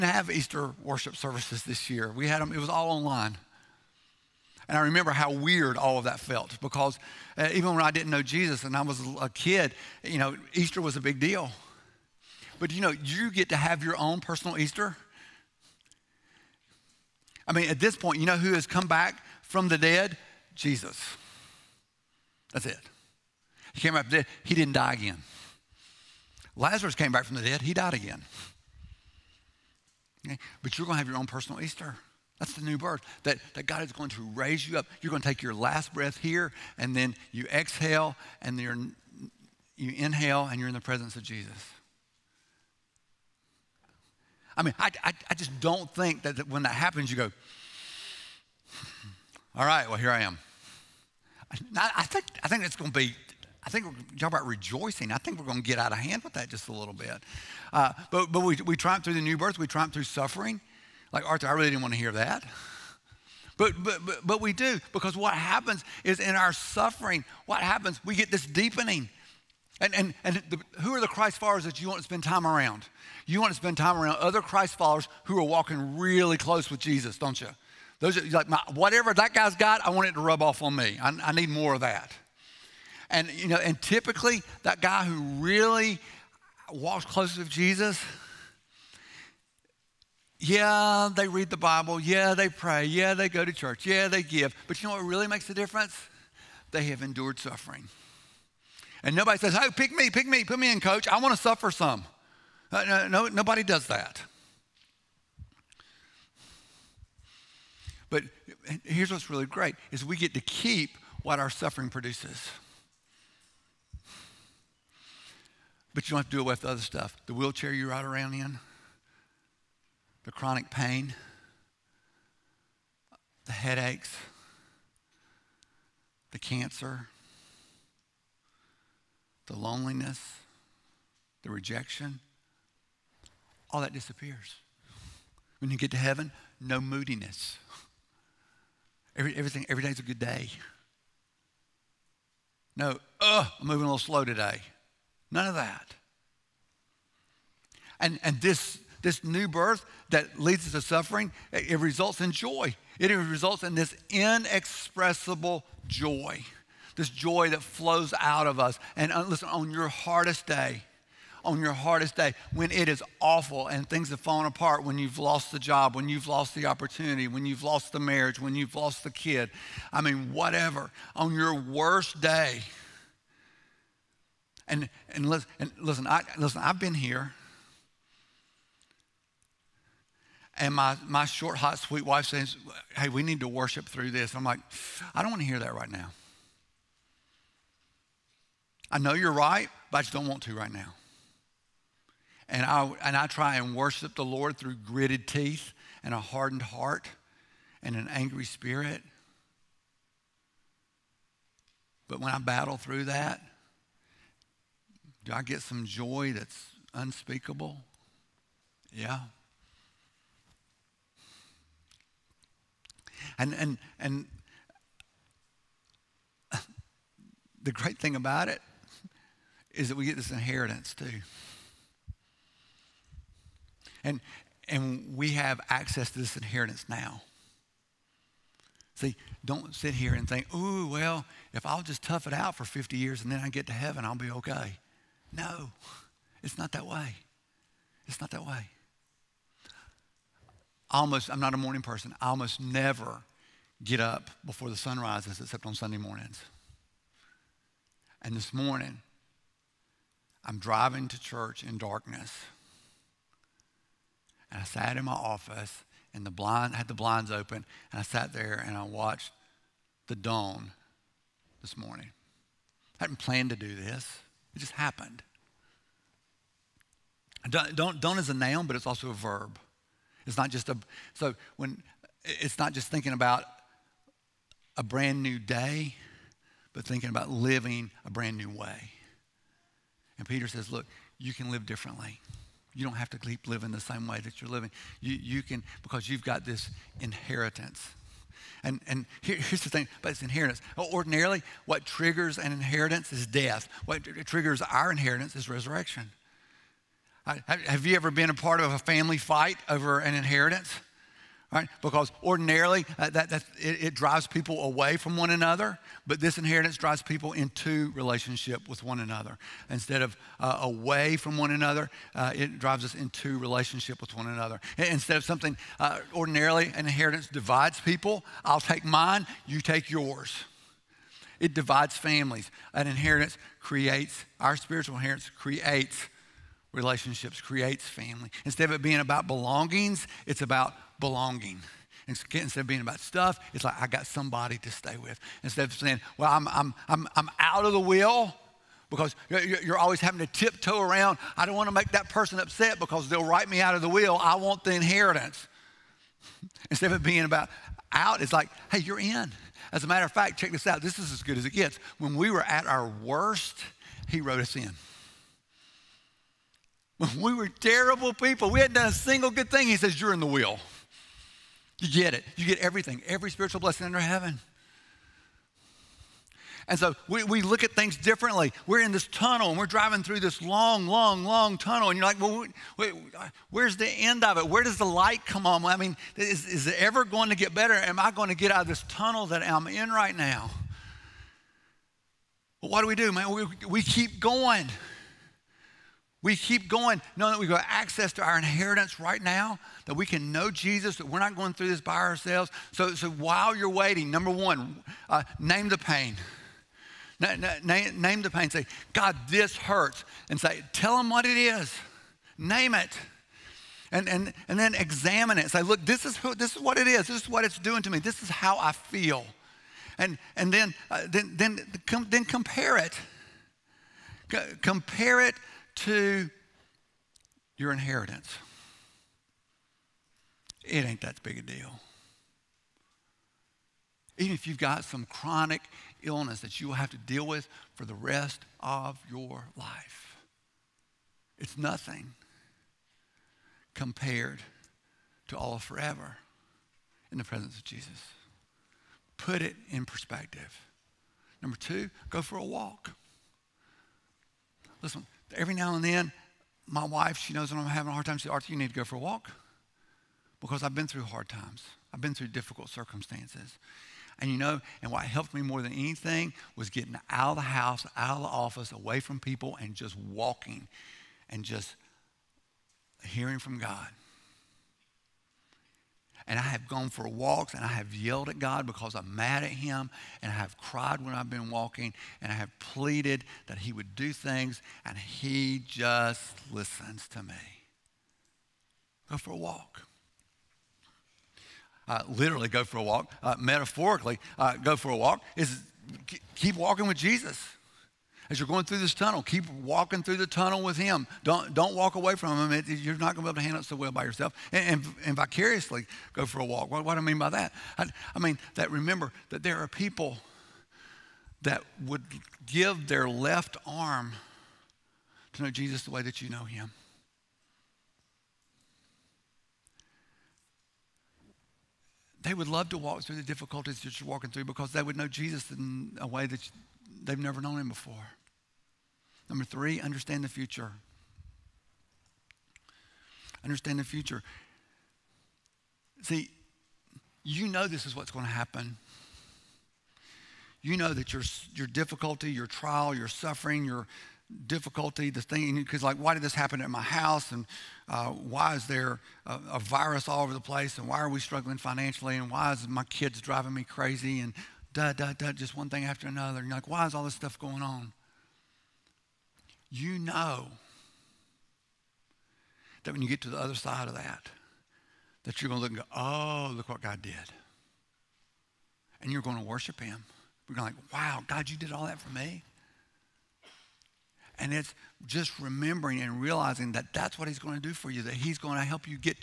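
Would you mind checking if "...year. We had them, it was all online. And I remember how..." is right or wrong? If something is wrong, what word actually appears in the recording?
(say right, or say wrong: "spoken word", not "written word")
right.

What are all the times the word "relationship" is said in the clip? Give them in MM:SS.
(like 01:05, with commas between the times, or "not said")
05:07, 05:13, 05:26.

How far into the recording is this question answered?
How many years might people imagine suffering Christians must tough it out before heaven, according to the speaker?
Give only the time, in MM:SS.
03:52.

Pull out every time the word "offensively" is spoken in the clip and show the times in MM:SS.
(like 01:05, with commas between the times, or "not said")
not said.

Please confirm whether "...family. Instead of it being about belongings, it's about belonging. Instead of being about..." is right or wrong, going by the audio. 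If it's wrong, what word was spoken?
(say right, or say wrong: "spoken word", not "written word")
right.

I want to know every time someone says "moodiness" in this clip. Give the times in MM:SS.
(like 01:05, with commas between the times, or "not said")
02:16.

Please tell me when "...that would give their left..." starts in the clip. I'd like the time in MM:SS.
08:21.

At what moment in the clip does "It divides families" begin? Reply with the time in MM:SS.
05:21.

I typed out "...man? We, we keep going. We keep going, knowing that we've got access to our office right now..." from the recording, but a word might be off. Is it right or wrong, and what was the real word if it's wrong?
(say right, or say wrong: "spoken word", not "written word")
wrong: "inheritance", not "office".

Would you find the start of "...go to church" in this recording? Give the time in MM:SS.
01:33.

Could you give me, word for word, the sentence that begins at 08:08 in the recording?
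As you're going through this tunnel, keep walking through the tunnel with him.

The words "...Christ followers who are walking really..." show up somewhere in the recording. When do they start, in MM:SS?
01:14.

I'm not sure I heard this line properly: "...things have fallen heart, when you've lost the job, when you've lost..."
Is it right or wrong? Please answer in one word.
wrong.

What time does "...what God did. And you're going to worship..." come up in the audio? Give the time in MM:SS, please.
09:16.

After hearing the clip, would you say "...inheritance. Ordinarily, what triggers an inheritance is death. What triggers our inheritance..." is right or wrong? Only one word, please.
right.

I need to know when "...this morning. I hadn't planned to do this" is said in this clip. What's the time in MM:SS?
04:21.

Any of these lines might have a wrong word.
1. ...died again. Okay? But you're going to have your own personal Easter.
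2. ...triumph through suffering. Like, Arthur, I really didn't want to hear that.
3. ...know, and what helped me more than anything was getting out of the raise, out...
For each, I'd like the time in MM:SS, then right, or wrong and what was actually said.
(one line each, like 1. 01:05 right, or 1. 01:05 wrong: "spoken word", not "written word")
1. 00:27 right
2. 00:59 right
3. 07:34 wrong: "house", not "raise".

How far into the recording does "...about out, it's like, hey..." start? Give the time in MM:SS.
05:47.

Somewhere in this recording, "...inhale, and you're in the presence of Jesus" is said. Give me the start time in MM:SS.
00:39.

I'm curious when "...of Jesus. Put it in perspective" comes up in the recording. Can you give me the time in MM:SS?
07:17.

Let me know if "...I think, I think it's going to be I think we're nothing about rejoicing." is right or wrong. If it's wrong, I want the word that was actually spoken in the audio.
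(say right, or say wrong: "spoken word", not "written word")
wrong: "talking", not "nothing".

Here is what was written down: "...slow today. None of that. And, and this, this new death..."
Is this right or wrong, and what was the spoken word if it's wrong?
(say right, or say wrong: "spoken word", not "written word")
wrong: "birth", not "death".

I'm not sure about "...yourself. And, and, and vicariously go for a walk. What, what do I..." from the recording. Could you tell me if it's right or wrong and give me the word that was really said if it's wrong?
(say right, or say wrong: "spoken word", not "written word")
right.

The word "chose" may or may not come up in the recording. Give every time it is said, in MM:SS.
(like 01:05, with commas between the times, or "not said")
not said.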